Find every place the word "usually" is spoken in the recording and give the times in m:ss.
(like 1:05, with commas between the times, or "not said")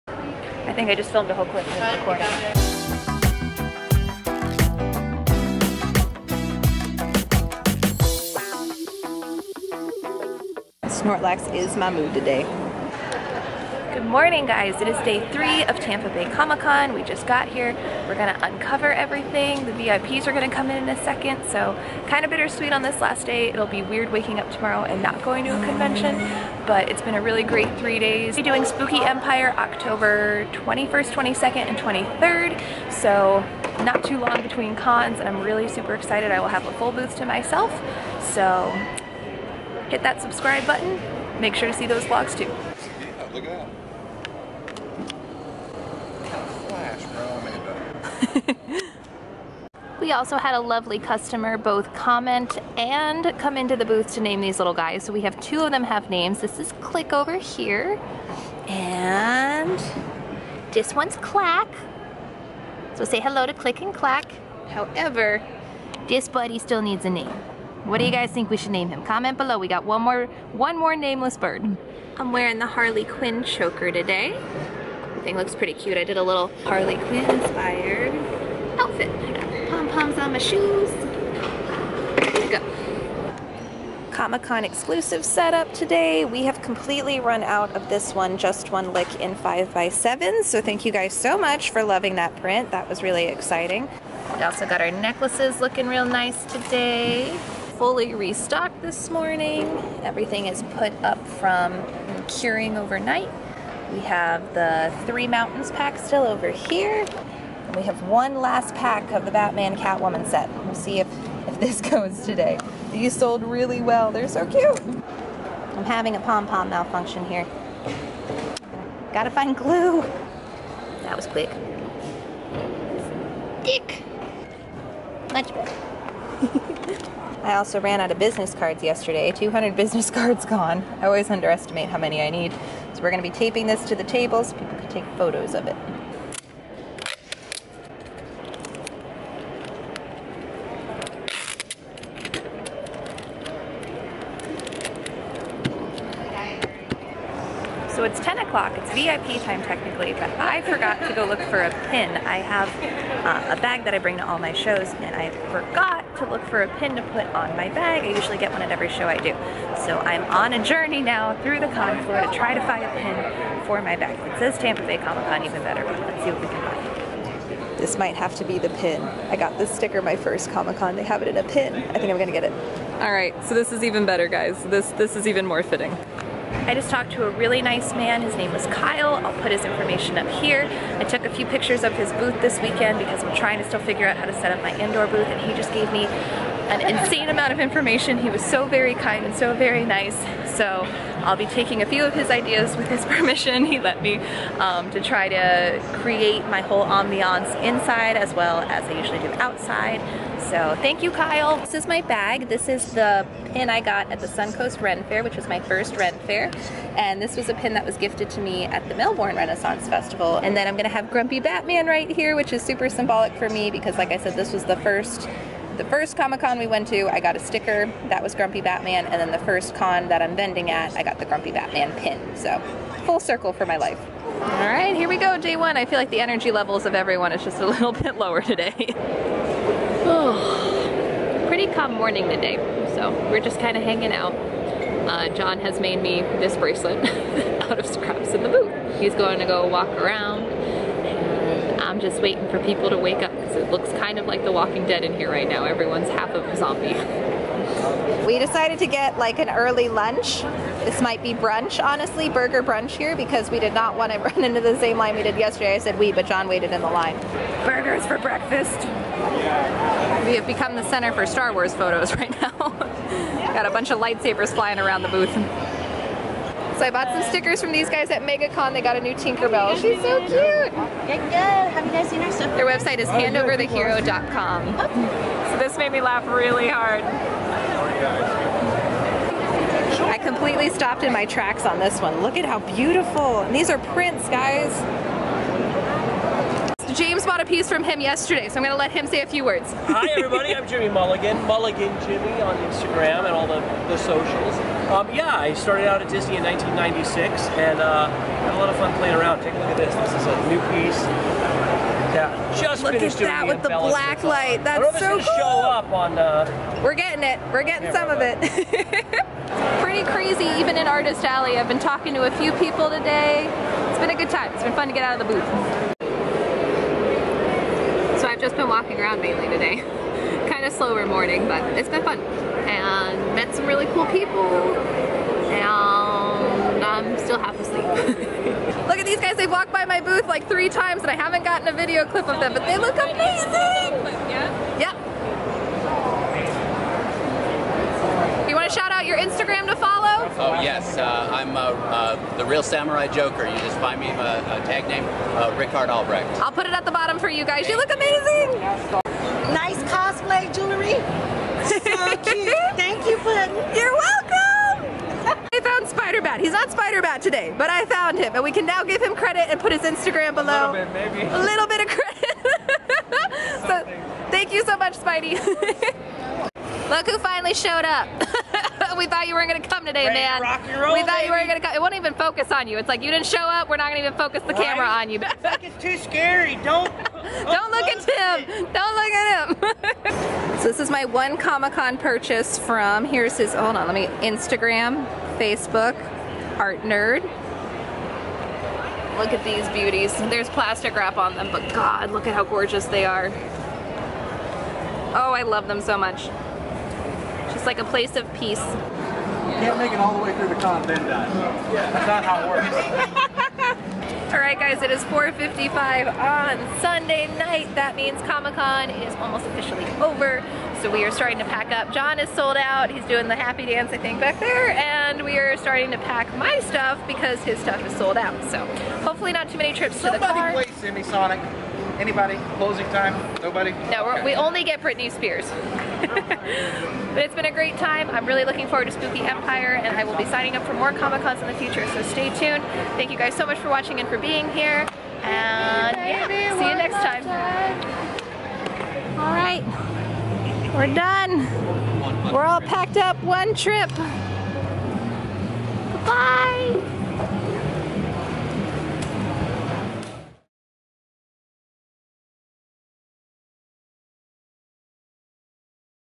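2:38, 3:18.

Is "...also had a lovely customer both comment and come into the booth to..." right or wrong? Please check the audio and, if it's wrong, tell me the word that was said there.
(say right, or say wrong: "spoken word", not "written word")
right.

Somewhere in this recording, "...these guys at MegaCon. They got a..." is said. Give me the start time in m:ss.
4:27.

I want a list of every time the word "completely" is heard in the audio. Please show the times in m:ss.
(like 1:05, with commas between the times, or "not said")
1:26, 4:40.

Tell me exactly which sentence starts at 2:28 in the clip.
It's VIP time technically, but I forgot to go look for a pin.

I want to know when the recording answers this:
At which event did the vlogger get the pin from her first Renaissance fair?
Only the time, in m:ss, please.
3:24.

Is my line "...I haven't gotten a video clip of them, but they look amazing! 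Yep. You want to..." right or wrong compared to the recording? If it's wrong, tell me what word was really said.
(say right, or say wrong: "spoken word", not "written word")
right.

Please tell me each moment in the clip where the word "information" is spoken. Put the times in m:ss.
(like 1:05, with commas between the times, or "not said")
2:59, 3:07.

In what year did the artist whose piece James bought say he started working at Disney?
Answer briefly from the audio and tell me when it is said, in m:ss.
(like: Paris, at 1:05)
1996, at 4:56.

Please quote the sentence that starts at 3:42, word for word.
So, full circle for my life.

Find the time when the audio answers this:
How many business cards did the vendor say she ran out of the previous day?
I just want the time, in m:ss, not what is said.
2:09.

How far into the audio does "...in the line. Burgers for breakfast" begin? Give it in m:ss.
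4:16.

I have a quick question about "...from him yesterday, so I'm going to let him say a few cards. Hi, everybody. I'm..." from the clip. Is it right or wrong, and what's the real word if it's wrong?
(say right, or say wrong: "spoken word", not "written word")
wrong: "words", not "cards".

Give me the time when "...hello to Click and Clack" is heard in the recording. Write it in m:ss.
1:03.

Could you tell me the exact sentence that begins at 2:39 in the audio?
So I'm on a journey now through the con floor to try to find a pin for my bag.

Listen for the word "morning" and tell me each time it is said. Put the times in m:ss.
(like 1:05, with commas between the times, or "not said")
0:14, 1:39, 3:51, 5:21.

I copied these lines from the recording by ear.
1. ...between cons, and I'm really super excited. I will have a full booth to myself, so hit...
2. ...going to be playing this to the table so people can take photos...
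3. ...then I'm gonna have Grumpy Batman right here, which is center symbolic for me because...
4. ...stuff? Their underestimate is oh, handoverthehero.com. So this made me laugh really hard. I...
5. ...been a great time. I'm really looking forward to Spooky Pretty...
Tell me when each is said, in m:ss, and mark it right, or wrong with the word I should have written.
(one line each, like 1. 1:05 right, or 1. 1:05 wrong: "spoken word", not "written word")
1. 0:34 right
2. 2:13 wrong: "taping", not "playing"
3. 3:30 wrong: "super", not "center"
4. 4:32 wrong: "website", not "underestimate"
5. 7:07 wrong: "Empire", not "Pretty".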